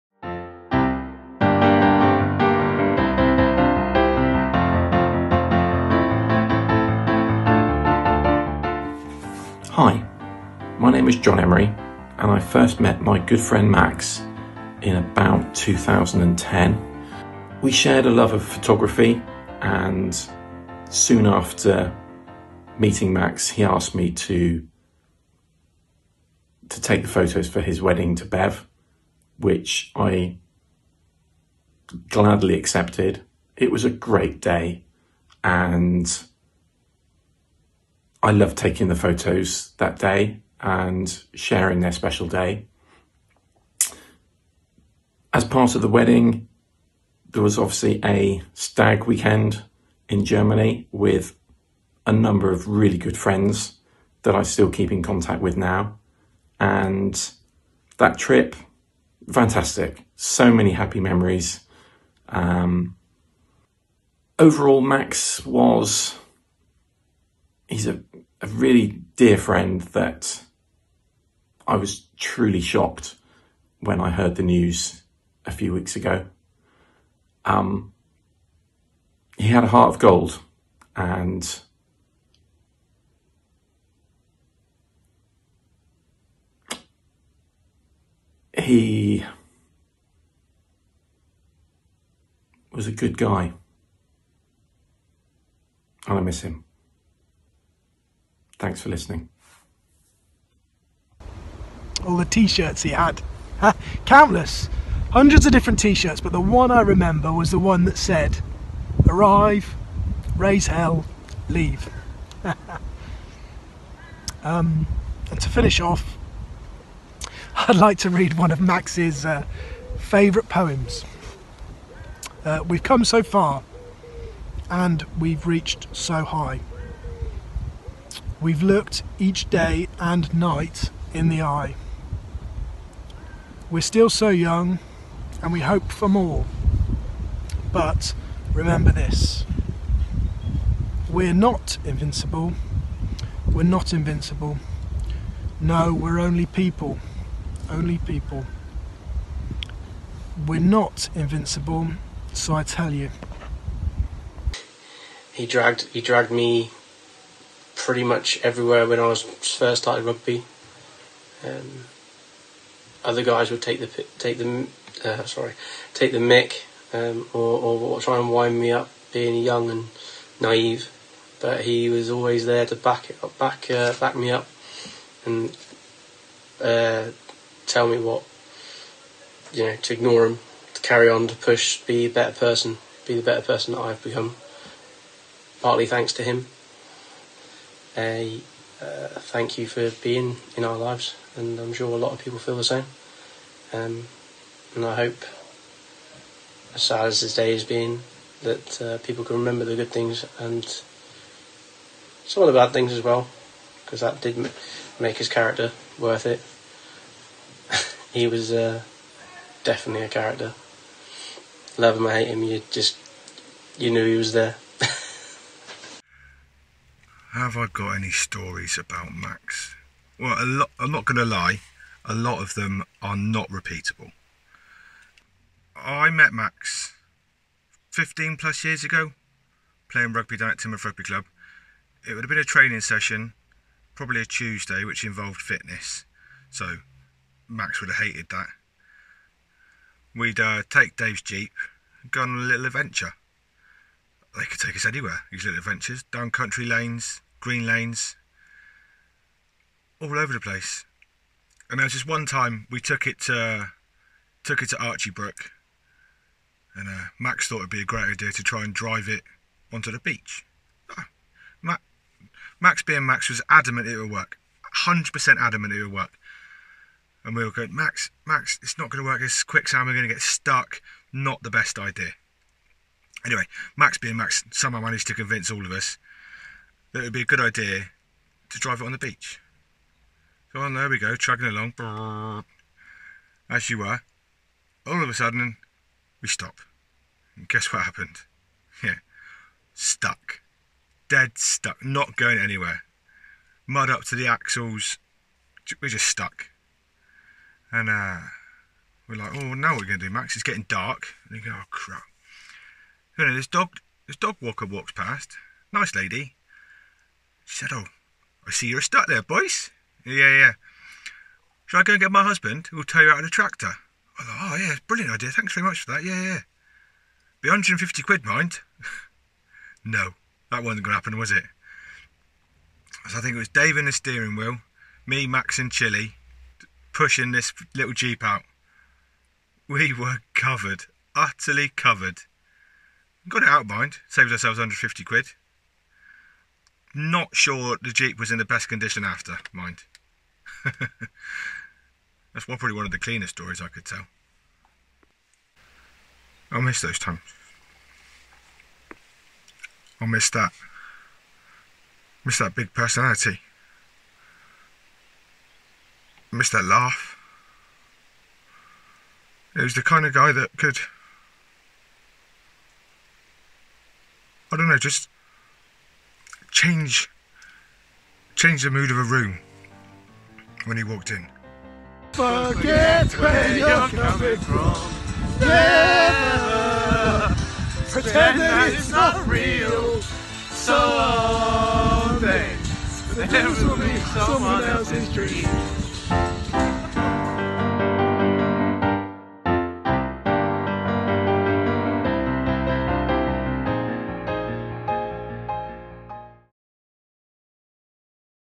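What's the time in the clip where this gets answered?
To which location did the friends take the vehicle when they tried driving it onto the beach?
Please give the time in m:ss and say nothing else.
4:14.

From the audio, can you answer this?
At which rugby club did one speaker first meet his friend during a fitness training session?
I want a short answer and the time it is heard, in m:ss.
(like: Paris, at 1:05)
Timber Rugby Club, at 3:50.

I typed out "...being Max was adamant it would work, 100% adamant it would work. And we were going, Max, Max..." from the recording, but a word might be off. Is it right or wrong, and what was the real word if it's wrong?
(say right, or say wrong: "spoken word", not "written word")
right.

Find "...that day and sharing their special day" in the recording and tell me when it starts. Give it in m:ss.
0:39.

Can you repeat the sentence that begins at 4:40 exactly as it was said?
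So oh, on, there we go, chugging along, as you were.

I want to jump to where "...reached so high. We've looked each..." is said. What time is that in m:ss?
2:05.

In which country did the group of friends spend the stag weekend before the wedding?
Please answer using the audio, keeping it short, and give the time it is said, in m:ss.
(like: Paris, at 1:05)
Germany, at 0:50.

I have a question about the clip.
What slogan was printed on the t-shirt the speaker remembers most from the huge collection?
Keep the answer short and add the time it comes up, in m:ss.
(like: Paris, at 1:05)
Arrive, raise hell, leave, at 1:49.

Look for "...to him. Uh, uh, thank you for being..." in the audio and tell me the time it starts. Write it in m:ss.
3:06.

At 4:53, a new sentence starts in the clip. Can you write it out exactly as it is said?
Mud up to the axles, we're just stuck.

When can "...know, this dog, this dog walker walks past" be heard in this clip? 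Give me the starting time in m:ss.
5:03.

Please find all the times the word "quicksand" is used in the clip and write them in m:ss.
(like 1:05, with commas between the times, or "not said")
4:29.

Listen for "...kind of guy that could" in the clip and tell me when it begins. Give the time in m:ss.
5:59.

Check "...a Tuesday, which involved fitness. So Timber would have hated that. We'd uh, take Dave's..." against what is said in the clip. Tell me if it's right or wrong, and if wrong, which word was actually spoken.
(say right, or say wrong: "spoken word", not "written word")
wrong: "Max", not "Timber".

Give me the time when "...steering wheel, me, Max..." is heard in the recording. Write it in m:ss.
5:23.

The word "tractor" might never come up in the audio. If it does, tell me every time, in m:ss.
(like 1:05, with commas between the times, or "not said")
5:13.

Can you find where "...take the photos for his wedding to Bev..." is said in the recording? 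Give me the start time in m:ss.
0:26.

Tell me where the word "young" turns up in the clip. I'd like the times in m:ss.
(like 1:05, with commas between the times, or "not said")
2:14, 2:49.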